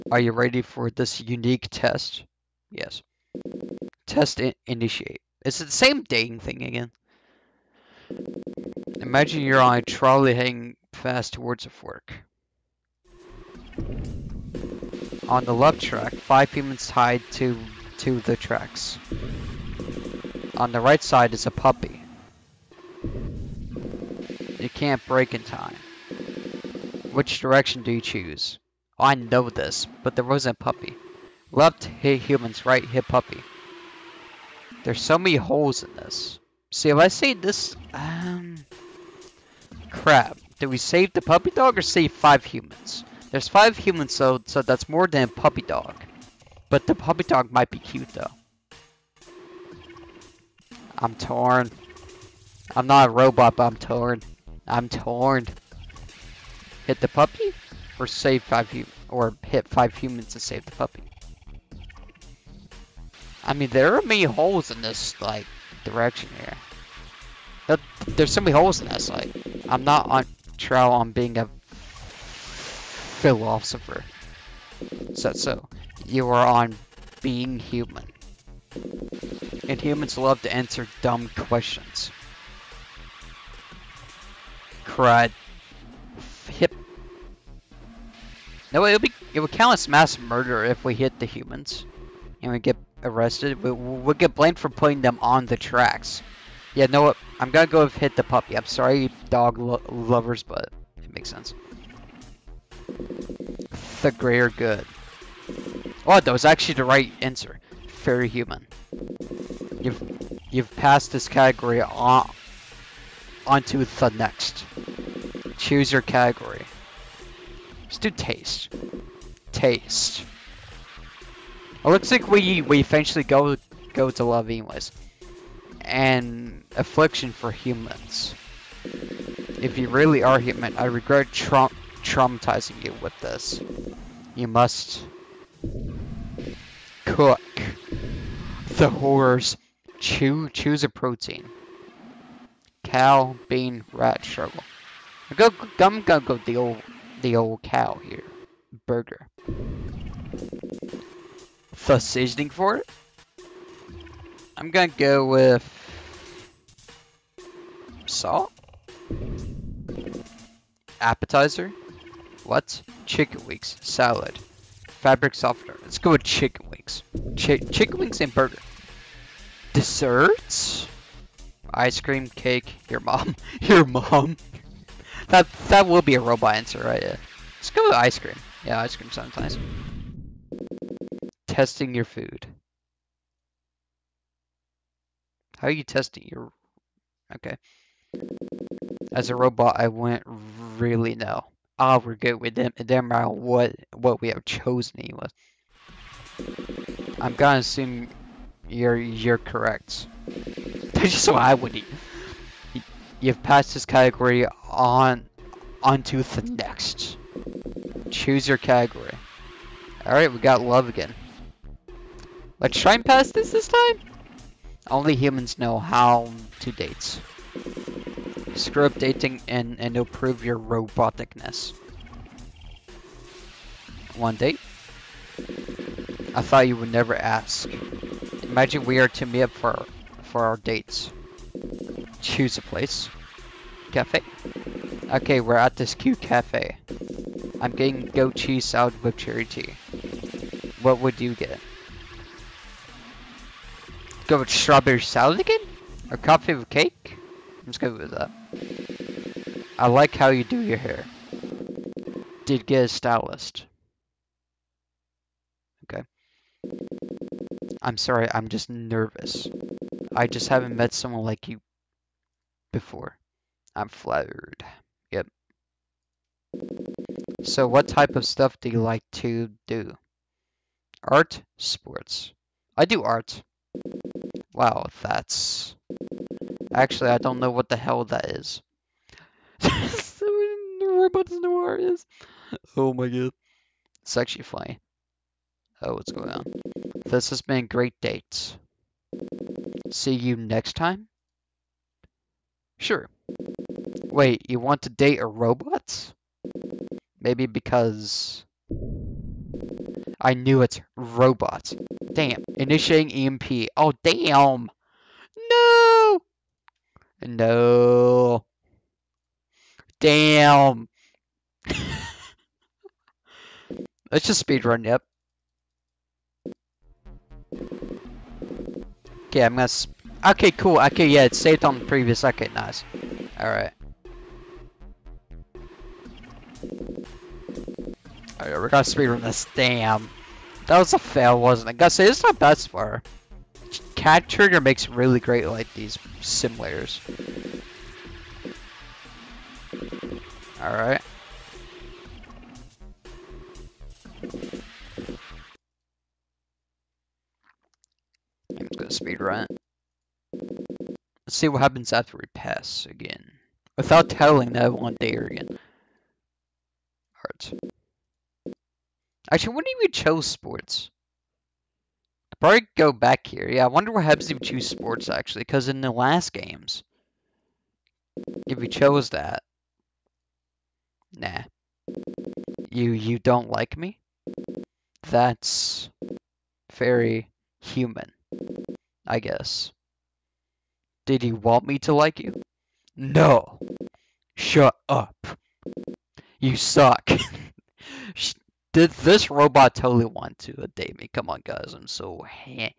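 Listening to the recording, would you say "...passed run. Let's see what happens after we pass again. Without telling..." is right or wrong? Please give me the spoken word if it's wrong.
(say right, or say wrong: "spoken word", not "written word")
wrong: "speed", not "passed".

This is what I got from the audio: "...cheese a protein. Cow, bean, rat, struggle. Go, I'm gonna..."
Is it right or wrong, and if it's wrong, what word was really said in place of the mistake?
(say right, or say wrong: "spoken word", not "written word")
wrong: "choose", not "cheese".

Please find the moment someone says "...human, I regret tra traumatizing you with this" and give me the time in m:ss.
2:10.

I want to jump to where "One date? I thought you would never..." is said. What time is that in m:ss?
3:44.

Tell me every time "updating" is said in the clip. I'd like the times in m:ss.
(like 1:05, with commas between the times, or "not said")
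3:38.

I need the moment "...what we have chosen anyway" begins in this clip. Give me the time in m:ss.
3:13.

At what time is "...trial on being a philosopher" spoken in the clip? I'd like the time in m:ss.
1:10.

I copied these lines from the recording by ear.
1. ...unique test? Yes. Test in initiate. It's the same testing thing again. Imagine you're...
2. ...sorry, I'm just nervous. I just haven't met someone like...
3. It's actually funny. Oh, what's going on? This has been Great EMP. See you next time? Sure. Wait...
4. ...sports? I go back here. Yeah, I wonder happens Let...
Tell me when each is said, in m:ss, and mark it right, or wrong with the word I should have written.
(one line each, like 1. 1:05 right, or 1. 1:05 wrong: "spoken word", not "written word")
1. 0:01 wrong: "dating", not "testing"
2. 4:17 right
3. 4:44 wrong: "Dates", not "EMP"
4. 6:00 wrong: "Hebs", not "Let".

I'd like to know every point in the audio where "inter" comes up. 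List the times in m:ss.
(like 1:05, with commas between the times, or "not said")
not said.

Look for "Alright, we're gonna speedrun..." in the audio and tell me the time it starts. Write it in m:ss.
5:28.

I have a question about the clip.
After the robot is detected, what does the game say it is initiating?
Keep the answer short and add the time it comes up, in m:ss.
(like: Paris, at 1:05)
EMP, at 5:03.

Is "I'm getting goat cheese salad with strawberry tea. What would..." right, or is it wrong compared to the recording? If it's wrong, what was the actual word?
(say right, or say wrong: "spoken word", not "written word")
wrong: "cherry", not "strawberry".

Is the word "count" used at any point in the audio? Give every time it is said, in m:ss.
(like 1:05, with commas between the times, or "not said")
1:29.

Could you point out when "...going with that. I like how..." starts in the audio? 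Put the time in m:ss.
4:07.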